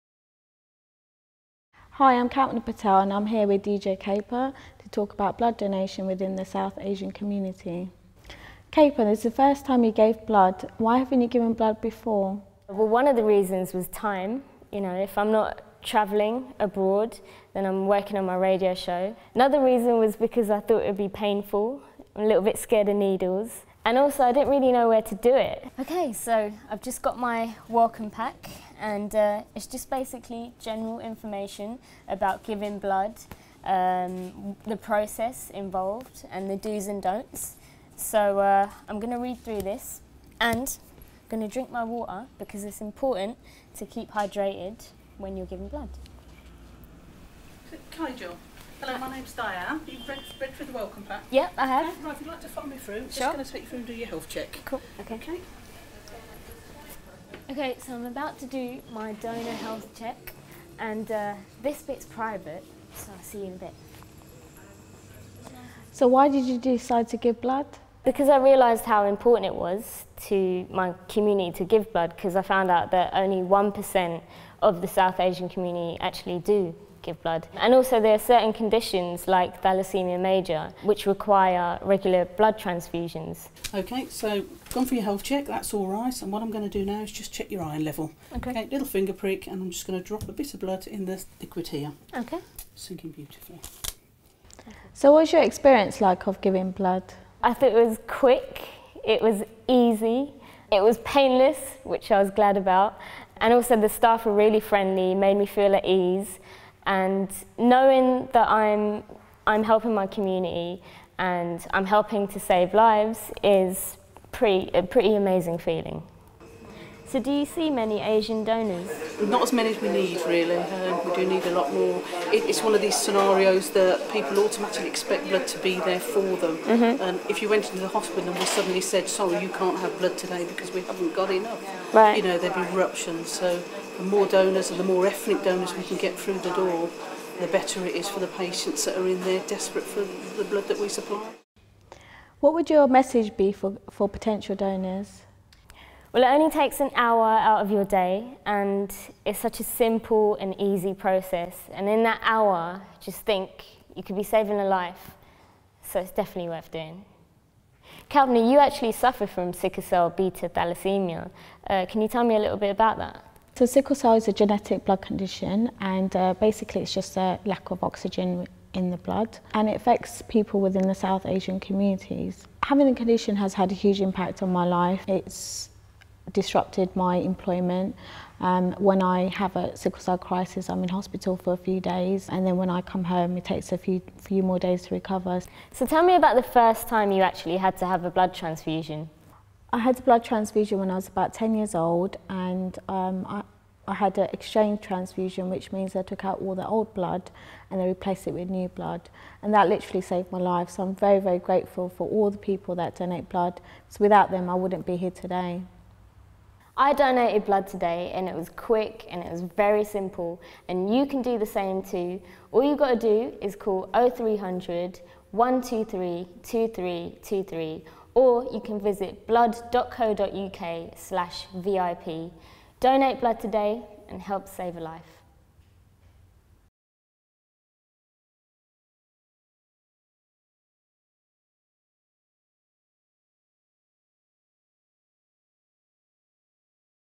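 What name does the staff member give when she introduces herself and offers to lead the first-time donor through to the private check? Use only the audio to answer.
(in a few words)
Diane.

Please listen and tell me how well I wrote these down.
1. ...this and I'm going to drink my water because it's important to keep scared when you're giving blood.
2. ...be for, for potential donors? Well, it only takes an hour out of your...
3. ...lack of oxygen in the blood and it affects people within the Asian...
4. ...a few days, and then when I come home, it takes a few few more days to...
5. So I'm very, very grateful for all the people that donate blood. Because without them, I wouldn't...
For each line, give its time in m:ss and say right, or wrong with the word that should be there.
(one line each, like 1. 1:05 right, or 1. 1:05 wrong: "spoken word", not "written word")
1. 0:39 wrong: "hydrated", not "scared"
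2. 2:23 right
3. 2:47 wrong: "South", not "Asian"
4. 3:01 right
5. 3:20 right.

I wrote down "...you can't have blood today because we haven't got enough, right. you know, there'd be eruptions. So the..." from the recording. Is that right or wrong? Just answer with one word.
right.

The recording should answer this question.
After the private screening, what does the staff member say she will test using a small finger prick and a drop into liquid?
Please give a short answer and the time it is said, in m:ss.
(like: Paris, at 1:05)
Iron level, at 1:27.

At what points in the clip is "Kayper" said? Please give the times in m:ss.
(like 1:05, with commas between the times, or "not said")
0:03, 0:08.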